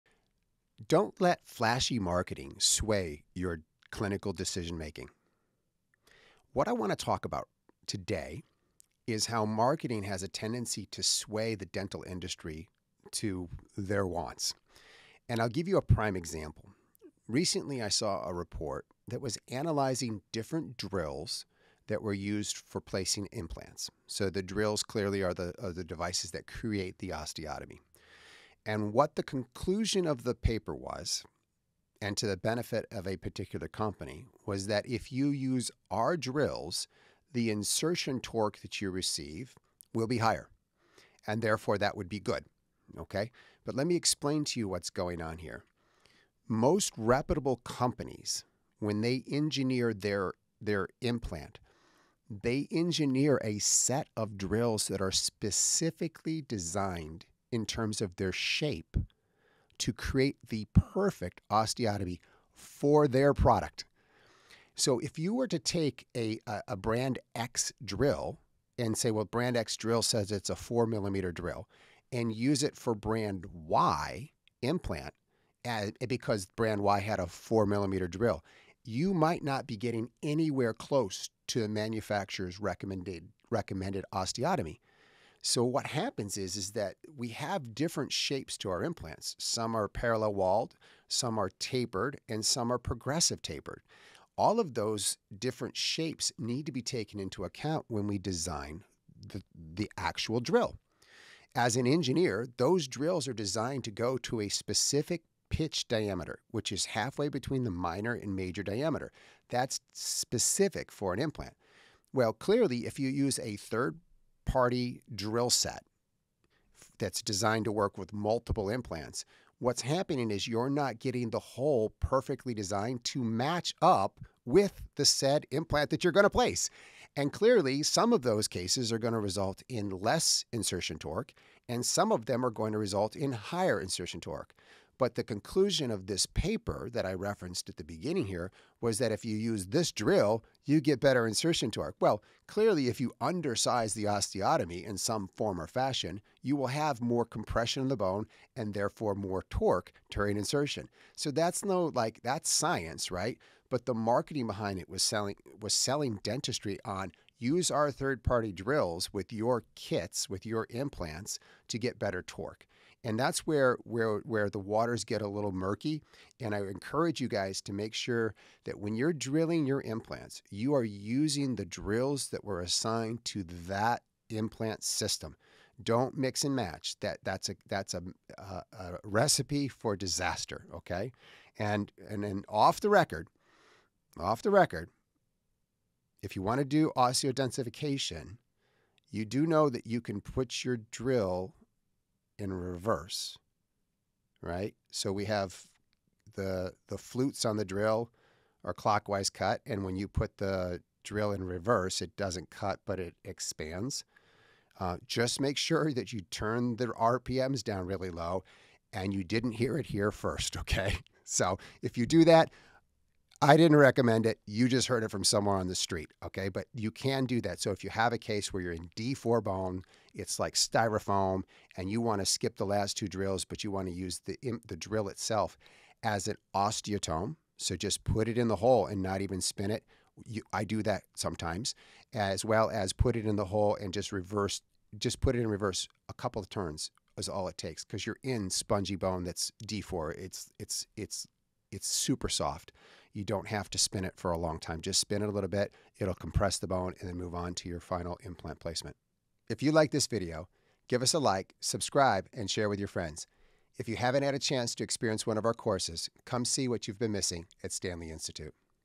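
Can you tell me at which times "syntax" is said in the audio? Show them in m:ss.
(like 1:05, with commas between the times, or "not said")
not said.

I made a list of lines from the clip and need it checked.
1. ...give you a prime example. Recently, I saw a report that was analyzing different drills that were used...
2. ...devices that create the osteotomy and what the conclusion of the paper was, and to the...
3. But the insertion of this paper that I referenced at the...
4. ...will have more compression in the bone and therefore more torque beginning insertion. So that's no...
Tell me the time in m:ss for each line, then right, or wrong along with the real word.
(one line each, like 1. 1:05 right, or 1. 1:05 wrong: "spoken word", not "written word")
1. 0:15 right
2. 0:25 right
3. 2:14 wrong: "conclusion", not "insertion"
4. 2:26 wrong: "during", not "beginning".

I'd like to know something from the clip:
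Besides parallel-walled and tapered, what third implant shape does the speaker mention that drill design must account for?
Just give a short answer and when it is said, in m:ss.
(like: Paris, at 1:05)
progressive tapered, at 1:32.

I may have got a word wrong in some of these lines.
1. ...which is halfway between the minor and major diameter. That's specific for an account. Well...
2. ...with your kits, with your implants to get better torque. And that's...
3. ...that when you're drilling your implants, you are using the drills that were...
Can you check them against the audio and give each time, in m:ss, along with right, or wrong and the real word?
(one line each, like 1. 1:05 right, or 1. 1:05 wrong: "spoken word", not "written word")
1. 1:46 wrong: "implant", not "account"
2. 2:39 right
3. 2:48 right.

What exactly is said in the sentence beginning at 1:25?
So what happens is is that we have different shapes to our implants.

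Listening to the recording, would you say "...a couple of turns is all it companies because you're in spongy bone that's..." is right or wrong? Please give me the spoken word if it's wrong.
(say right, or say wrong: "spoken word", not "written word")
wrong: "takes", not "companies".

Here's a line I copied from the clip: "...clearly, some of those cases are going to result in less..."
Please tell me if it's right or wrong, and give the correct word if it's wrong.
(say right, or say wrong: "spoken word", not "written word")
right.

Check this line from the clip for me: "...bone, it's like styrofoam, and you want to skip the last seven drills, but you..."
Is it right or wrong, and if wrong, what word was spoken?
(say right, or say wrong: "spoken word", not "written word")
wrong: "two", not "seven".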